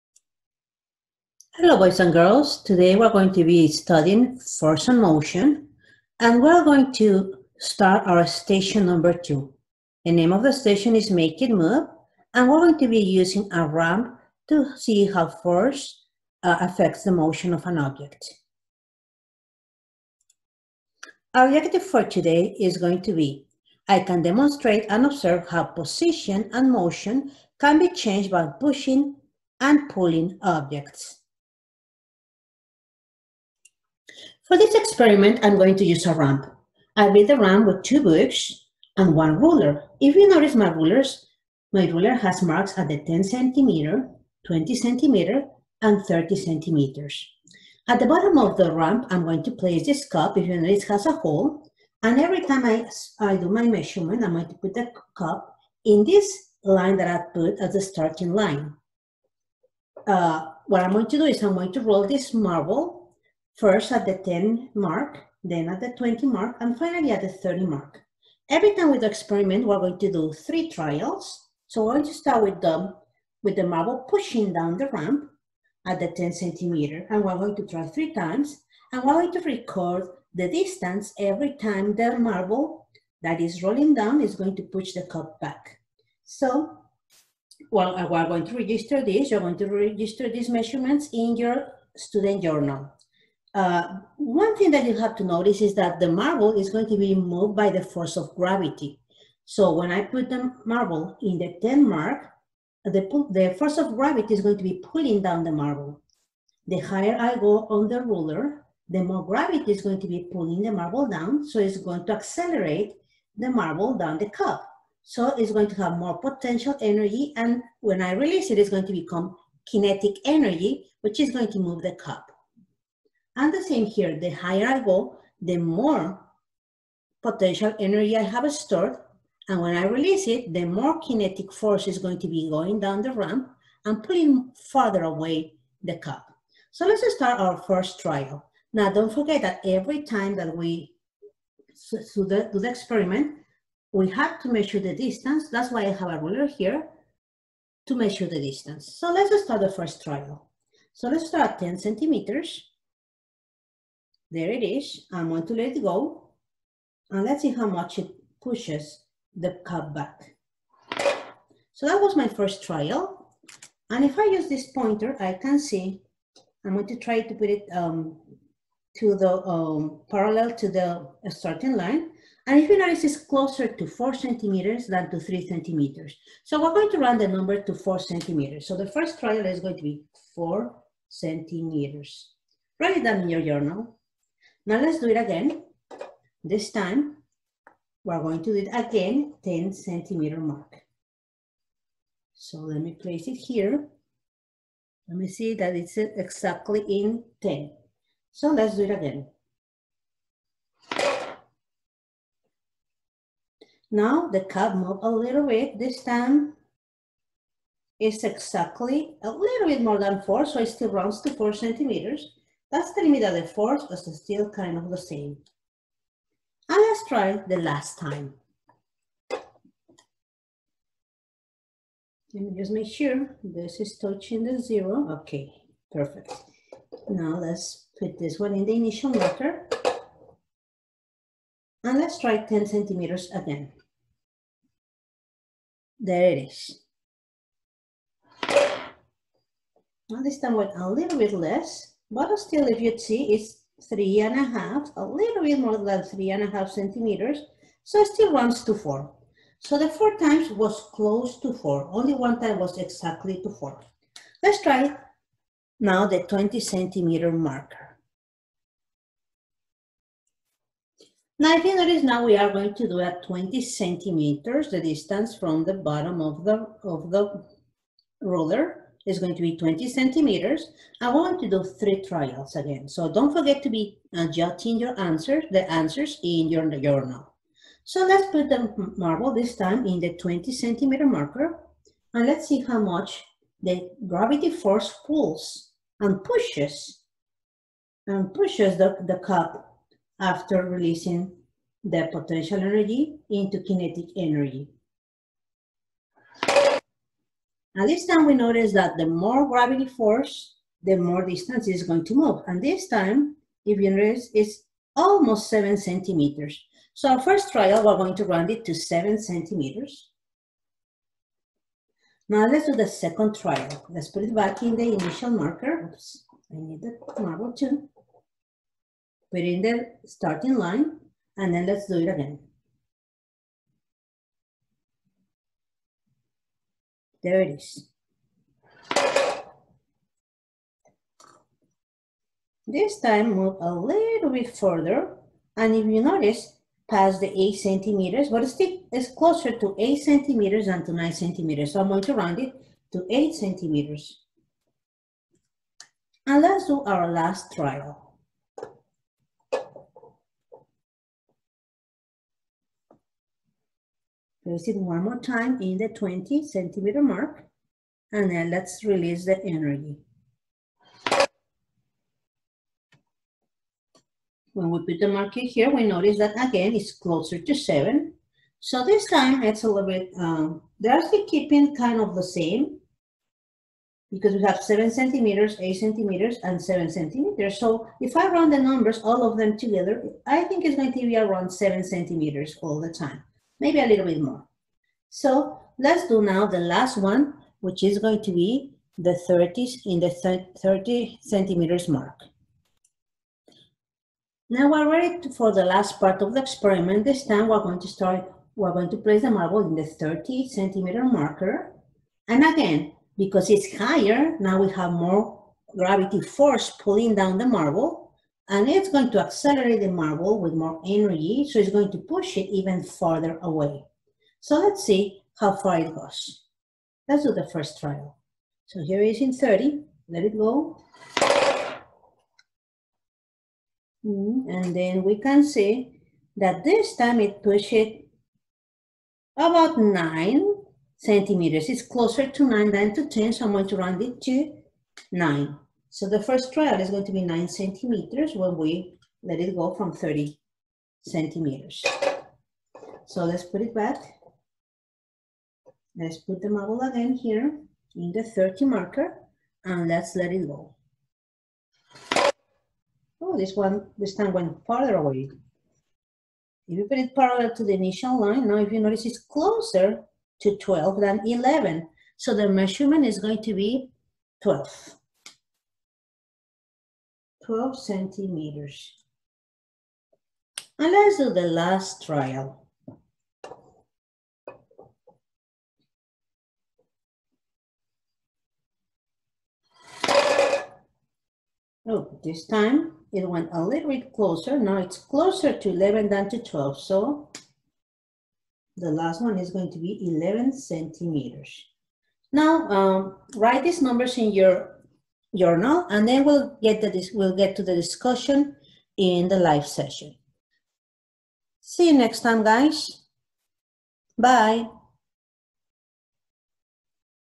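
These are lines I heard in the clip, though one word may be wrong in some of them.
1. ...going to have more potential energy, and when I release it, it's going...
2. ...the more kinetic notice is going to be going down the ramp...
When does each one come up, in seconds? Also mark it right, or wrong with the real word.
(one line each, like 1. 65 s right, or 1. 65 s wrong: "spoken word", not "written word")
1. 115 s right
2. 130 s wrong: "force", not "notice".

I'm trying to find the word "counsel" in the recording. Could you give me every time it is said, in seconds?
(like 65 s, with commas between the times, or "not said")
not said.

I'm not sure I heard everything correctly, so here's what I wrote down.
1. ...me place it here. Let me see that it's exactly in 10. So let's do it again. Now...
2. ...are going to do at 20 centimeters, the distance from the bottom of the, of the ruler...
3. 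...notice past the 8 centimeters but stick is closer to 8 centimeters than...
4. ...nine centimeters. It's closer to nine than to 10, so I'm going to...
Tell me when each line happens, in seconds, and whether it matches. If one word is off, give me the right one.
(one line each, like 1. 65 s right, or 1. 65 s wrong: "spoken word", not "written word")
1. 192 s right
2. 262 s right
3. 336 s right
4. 429 s right.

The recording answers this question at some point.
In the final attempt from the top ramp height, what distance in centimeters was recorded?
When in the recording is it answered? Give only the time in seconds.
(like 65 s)
490 s.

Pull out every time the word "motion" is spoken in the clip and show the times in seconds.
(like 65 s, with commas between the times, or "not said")
5 s, 17 s, 26 s.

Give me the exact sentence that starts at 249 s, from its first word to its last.
So the four times was close to four.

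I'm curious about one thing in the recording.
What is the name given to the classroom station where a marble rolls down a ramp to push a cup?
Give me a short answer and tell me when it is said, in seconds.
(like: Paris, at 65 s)
Make It Move, at 11 s.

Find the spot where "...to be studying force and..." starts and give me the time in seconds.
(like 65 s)
3 s.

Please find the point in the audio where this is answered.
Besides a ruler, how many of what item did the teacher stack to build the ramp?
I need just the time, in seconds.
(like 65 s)
37 s.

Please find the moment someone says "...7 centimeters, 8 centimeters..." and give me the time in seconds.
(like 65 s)
374 s.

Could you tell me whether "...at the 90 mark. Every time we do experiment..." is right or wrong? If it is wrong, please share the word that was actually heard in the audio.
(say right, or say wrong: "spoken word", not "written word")
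wrong: "30", not "90".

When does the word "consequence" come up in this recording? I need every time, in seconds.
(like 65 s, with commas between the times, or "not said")
not said.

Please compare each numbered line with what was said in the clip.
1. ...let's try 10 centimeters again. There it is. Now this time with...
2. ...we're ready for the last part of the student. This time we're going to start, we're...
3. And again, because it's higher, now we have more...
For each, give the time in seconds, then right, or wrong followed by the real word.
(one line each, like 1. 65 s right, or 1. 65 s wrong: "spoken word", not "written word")
1. 231 s right
2. 394 s wrong: "experiment", not "student"
3. 402 s right.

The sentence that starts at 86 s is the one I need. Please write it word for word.
So well, uh, we're going to register this.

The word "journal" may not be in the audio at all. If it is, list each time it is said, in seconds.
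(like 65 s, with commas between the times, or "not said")
92 s, 183 s, 276 s, 495 s.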